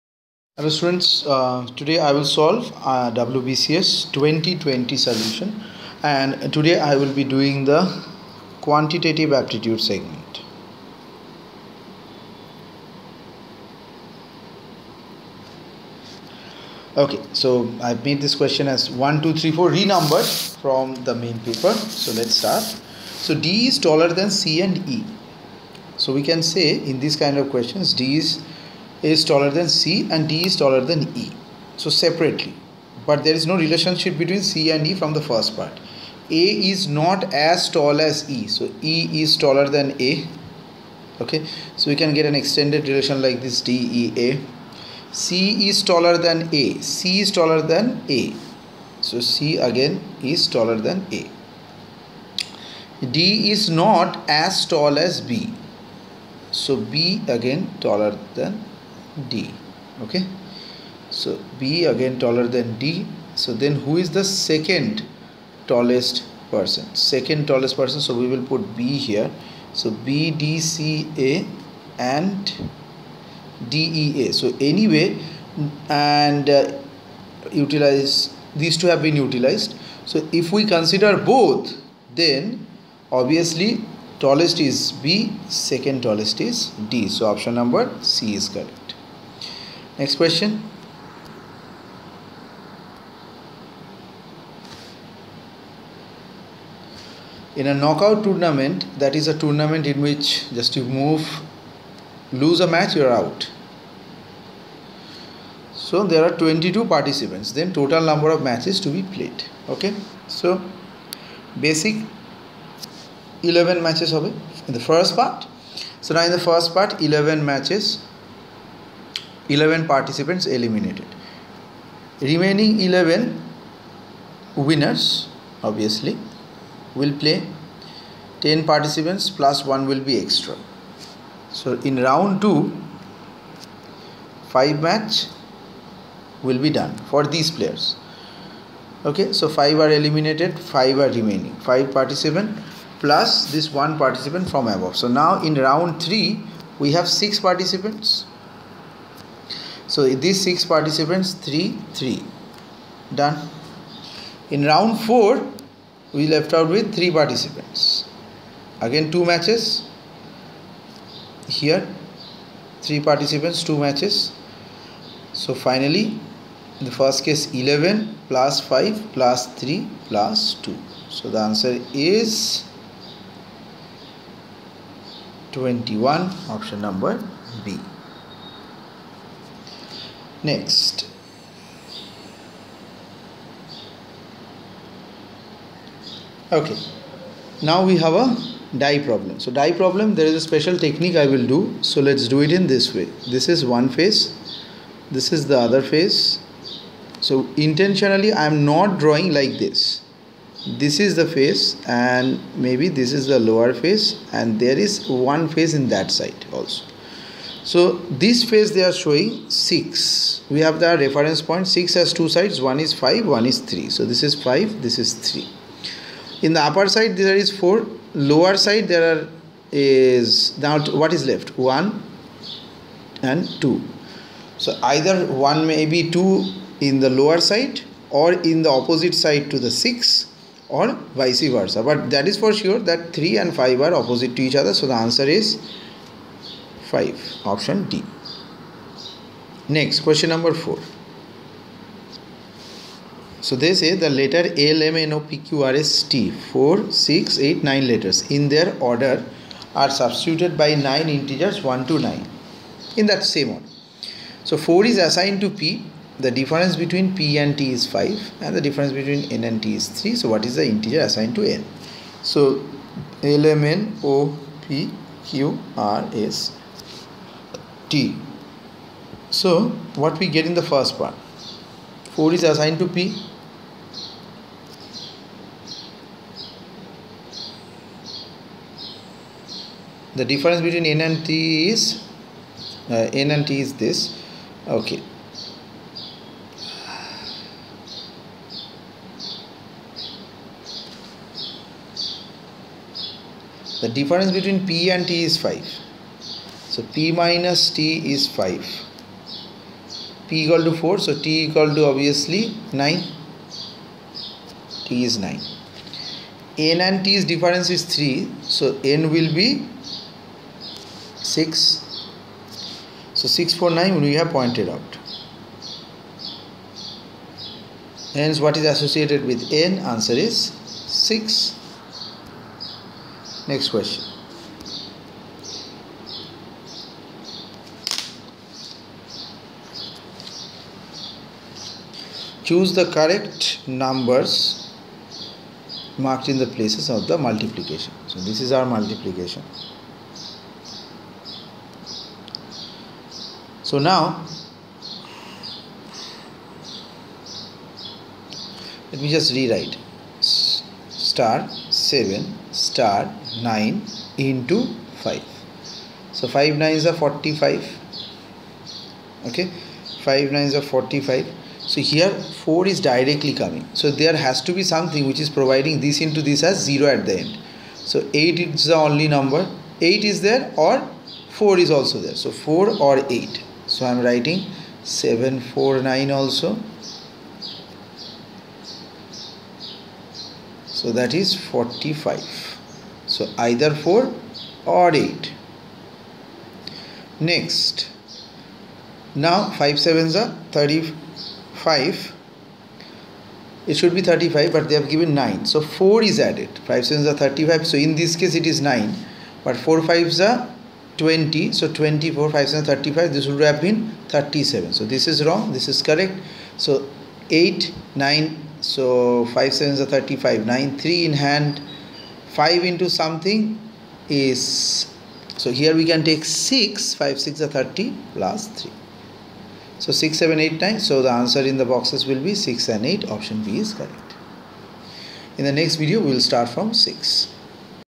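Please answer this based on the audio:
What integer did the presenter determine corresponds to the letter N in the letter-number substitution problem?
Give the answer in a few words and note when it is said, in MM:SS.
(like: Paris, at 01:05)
6, at 05:19.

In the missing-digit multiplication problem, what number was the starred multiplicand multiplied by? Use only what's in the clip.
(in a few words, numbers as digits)
5.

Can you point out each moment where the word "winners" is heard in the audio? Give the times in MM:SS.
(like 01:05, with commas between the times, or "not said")
02:04.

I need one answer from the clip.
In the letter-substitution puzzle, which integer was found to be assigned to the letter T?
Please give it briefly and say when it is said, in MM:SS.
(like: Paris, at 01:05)
9, at 05:04.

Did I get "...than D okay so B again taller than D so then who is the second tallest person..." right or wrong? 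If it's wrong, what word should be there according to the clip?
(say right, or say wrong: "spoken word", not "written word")
right.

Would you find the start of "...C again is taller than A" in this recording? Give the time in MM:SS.
00:49.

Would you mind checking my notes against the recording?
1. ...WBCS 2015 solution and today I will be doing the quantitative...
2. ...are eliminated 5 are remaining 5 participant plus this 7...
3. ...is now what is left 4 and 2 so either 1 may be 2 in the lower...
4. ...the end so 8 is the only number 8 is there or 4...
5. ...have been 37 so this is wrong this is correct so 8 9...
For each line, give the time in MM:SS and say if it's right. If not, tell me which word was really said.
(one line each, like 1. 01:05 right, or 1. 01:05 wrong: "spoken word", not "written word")
1. 00:03 wrong: "2020", not "2015"
2. 02:19 wrong: "1", not "7"
3. 03:39 wrong: "1", not "4"
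4. 06:07 right
5. 06:43 right.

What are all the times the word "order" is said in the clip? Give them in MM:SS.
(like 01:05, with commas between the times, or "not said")
04:08, 04:13.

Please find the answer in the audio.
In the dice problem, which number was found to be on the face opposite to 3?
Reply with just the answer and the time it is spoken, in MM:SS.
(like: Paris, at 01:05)
5, at 03:54.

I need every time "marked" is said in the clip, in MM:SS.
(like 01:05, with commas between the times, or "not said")
05:35.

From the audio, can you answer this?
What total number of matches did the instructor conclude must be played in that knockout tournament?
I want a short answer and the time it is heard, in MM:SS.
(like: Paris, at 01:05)
21, at 02:51.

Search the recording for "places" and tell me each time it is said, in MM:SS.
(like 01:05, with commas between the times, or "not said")
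05:36.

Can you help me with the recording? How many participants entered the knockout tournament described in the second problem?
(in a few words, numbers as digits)
22.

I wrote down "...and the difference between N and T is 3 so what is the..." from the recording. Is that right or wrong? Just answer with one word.
right.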